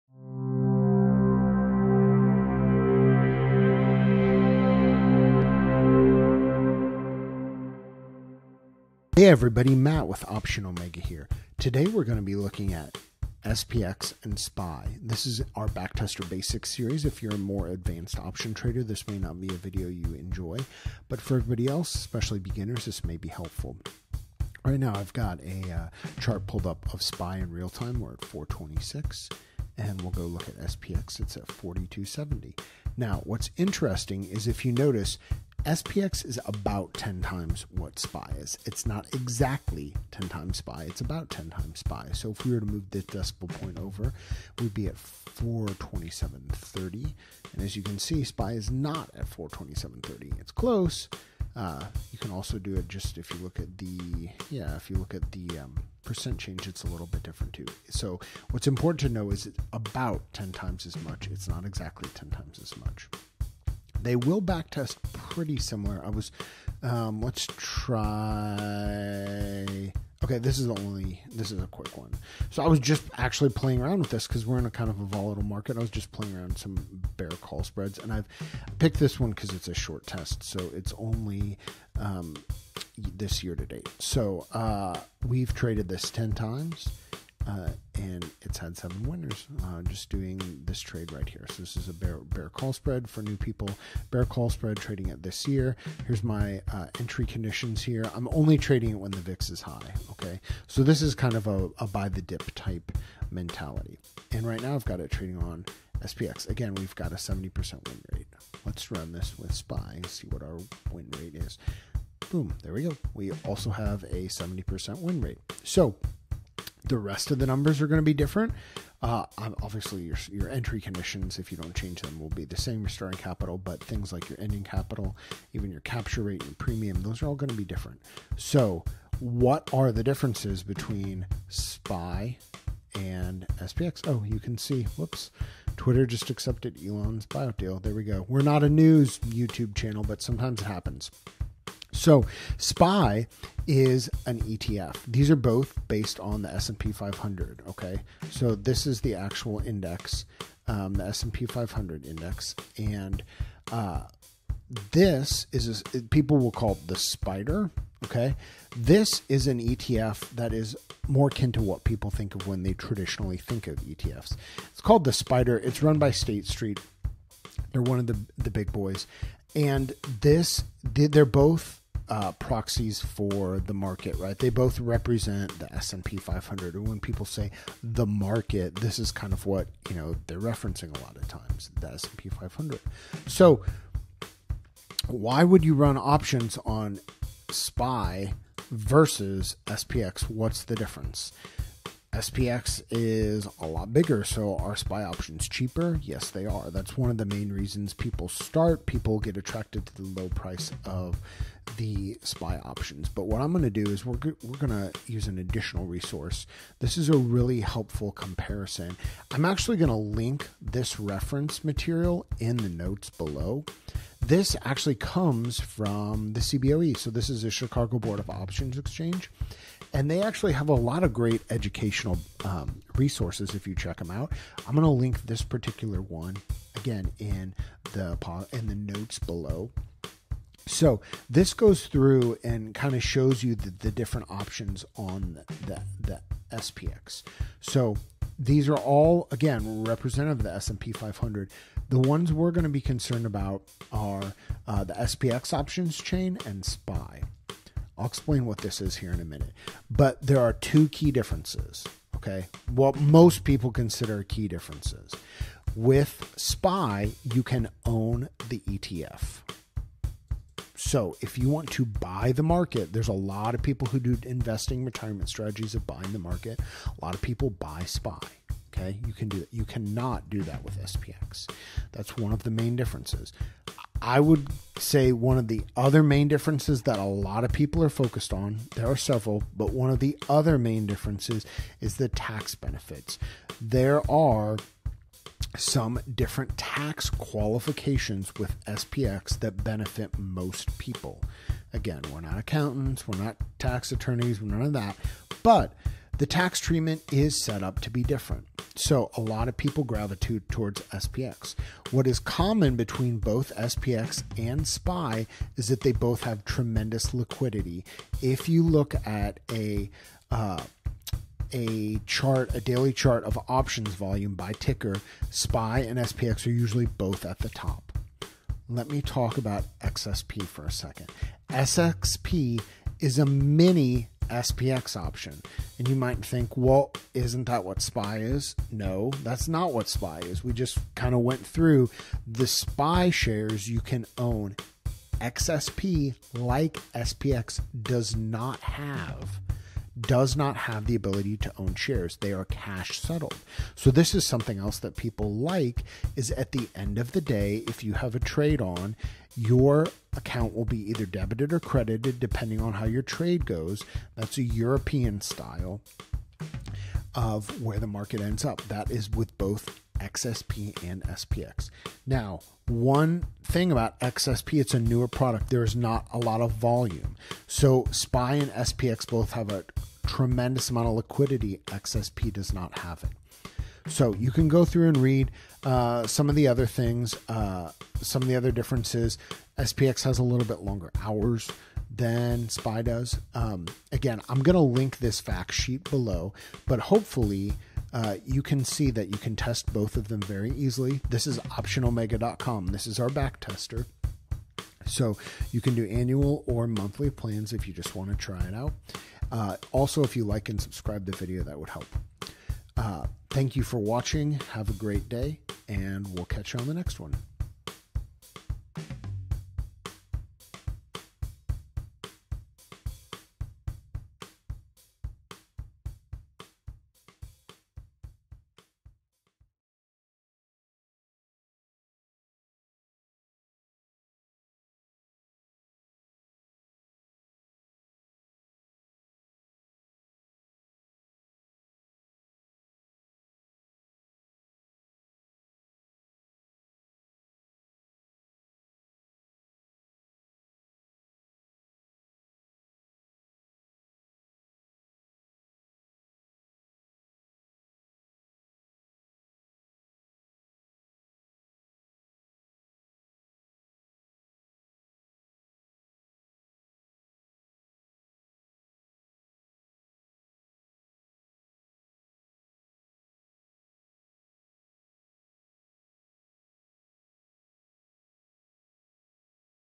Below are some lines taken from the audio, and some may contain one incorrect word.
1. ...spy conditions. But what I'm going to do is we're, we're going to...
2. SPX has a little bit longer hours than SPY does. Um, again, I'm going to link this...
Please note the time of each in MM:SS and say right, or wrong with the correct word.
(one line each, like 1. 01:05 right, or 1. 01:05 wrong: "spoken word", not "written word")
1. 03:22 wrong: "options", not "conditions"
2. 06:19 right.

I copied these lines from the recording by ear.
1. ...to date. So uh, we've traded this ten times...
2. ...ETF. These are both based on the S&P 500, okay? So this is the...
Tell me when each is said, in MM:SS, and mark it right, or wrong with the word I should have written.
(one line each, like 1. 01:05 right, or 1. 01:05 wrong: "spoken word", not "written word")
1. 01:23 right
2. 02:24 right.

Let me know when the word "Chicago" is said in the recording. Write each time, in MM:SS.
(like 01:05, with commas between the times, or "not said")
03:37.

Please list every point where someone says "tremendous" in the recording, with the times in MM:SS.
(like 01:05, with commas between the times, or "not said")
05:06, 06:10.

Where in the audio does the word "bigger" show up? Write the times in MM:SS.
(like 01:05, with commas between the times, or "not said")
03:13.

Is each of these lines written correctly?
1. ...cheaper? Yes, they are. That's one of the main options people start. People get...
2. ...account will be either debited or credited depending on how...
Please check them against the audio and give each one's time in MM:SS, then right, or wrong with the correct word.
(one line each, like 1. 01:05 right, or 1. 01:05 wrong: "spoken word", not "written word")
1. 03:15 wrong: "reasons", not "options"
2. 05:50 right.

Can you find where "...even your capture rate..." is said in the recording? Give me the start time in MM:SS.
02:05.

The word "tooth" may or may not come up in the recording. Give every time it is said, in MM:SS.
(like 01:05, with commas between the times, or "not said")
not said.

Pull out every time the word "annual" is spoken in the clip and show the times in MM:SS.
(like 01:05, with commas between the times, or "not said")
06:35.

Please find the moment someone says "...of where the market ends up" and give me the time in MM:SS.
05:57.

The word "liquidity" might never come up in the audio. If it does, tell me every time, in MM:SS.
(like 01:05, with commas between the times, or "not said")
05:07, 06:10.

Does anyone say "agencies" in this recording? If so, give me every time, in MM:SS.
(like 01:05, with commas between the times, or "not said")
not said.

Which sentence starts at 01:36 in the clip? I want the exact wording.
Here's my uh, entry conditions here.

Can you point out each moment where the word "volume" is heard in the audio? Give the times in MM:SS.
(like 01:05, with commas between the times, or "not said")
05:13, 06:06.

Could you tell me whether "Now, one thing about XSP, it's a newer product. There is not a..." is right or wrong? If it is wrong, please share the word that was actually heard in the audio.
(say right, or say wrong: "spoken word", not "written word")
right.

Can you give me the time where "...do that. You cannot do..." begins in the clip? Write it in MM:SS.
04:29.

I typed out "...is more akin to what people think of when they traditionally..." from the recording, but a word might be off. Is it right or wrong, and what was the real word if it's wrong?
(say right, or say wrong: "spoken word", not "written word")
right.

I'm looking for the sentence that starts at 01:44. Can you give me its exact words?
And right now I've got it trading on SPX.